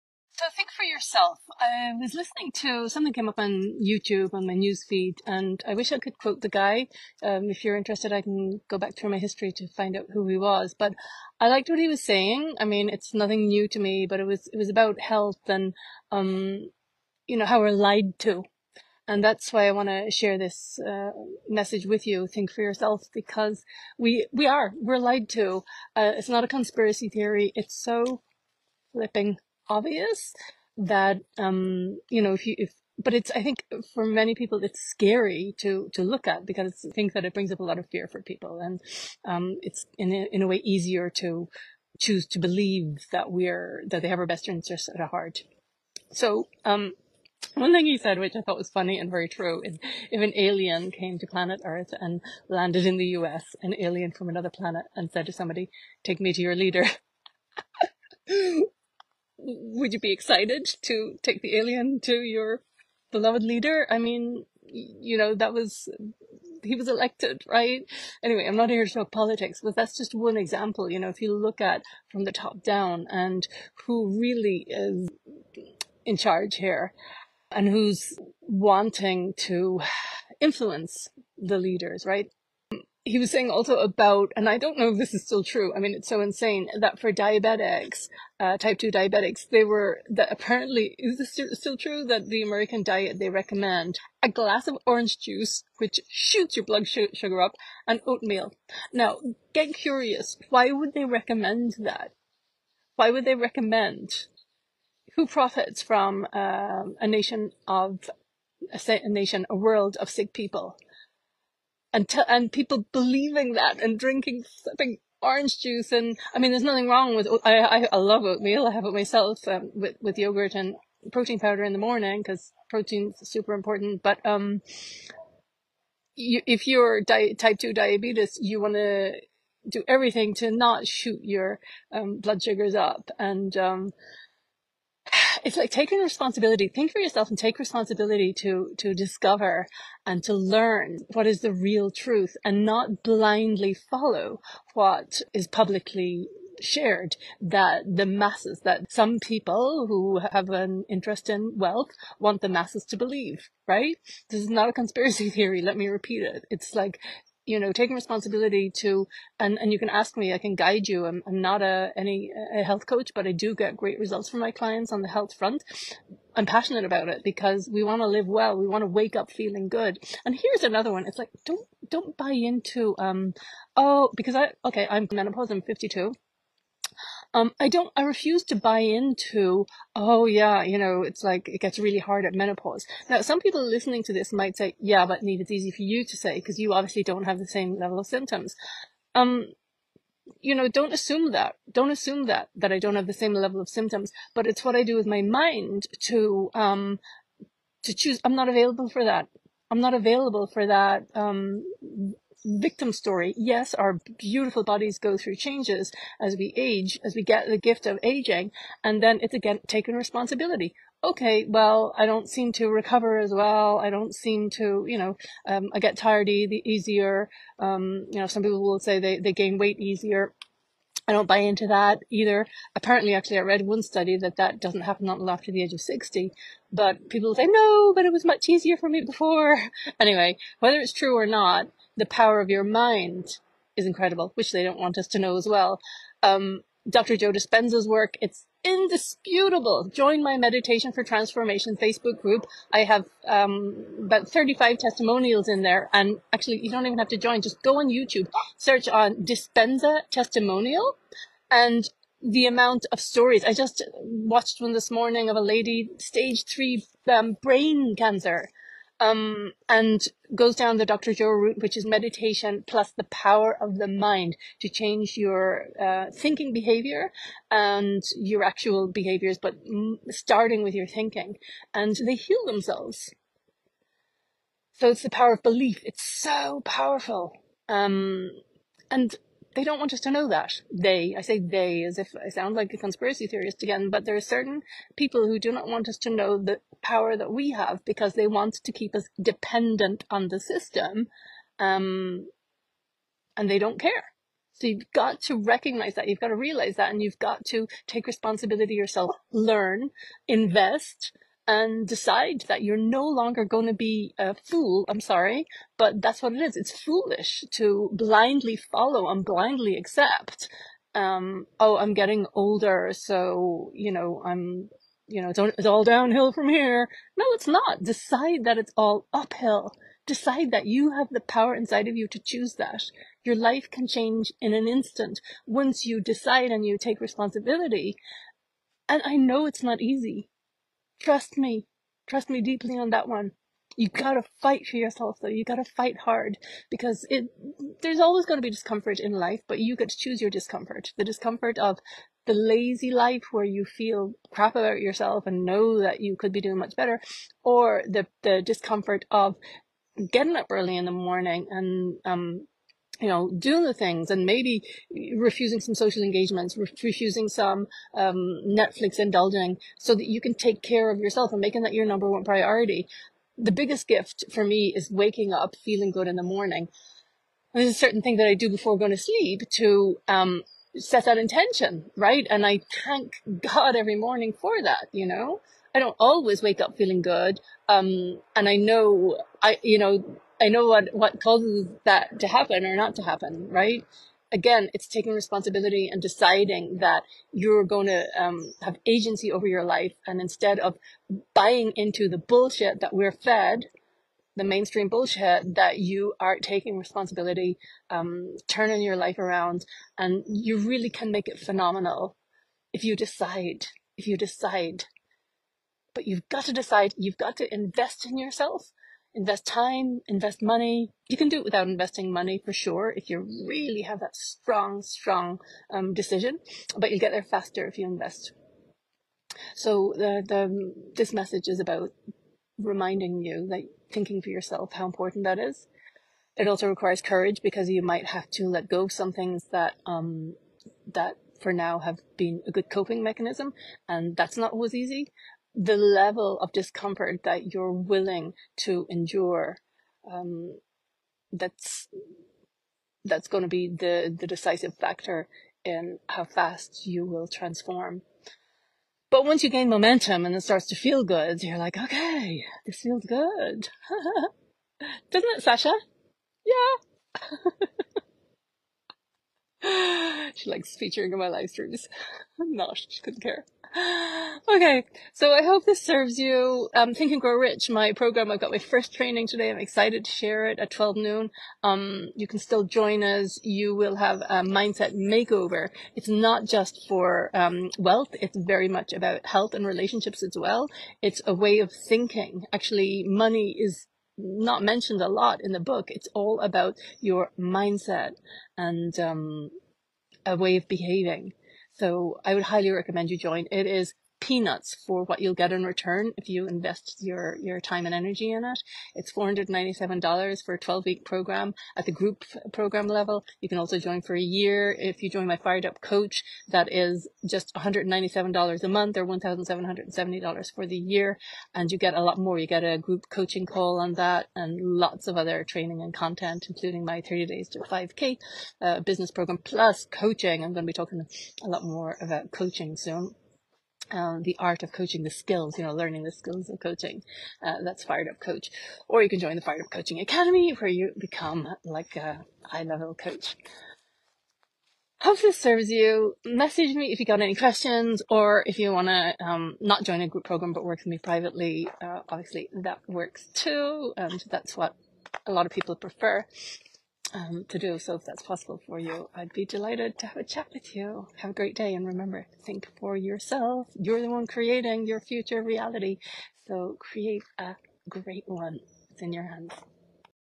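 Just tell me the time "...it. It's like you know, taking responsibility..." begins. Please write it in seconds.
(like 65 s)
156 s.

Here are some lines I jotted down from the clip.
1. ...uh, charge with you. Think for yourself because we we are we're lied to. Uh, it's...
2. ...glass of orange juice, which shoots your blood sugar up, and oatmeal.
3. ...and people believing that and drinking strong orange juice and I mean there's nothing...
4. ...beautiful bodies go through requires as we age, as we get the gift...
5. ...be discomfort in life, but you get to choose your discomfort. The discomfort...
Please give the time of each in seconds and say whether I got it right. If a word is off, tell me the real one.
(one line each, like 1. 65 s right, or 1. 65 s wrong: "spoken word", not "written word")
1. 20 s wrong: "message", not "charge"
2. 94 s right
3. 112 s wrong: "sipping", not "strong"
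4. 204 s wrong: "changes", not "requires"
5. 338 s right.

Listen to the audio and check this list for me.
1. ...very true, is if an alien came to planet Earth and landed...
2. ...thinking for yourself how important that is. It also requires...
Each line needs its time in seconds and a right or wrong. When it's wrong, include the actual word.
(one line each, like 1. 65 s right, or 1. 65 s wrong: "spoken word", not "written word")
1. 49 s right
2. 423 s right.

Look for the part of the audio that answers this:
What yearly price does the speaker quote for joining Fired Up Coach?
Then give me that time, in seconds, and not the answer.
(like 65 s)
509 s.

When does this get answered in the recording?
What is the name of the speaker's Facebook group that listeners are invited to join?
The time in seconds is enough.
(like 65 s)
240 s.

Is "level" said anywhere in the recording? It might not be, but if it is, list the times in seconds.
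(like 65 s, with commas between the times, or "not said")
187 s, 193 s, 435 s, 502 s, 532 s.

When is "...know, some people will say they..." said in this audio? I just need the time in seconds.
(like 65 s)
218 s.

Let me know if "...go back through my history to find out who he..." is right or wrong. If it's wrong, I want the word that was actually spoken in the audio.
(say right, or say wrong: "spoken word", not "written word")
right.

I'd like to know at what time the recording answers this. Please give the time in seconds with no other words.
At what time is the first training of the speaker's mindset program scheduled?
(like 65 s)
470 s.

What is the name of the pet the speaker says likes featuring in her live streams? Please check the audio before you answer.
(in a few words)
Sasha.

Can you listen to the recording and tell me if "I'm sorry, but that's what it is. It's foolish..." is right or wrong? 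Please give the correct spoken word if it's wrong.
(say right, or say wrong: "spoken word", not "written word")
right.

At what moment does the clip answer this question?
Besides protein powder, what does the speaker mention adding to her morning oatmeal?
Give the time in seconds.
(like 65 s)
120 s.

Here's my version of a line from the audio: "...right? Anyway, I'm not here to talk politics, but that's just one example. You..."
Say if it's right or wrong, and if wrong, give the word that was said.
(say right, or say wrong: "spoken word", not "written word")
right.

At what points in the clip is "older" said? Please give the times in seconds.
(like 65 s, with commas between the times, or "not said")
312 s.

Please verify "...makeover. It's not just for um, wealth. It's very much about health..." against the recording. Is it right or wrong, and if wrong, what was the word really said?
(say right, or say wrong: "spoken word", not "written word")
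right.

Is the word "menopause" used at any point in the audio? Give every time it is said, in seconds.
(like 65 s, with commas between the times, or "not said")
175 s, 182 s.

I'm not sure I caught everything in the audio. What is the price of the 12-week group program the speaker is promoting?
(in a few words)
$497.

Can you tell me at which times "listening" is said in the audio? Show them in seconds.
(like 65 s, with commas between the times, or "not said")
2 s, 183 s.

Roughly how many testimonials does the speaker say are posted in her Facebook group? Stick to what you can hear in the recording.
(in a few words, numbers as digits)
35.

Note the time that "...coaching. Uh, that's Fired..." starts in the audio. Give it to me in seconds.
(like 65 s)
526 s.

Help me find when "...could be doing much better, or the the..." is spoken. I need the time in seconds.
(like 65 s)
346 s.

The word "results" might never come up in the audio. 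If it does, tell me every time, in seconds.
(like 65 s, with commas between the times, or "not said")
163 s.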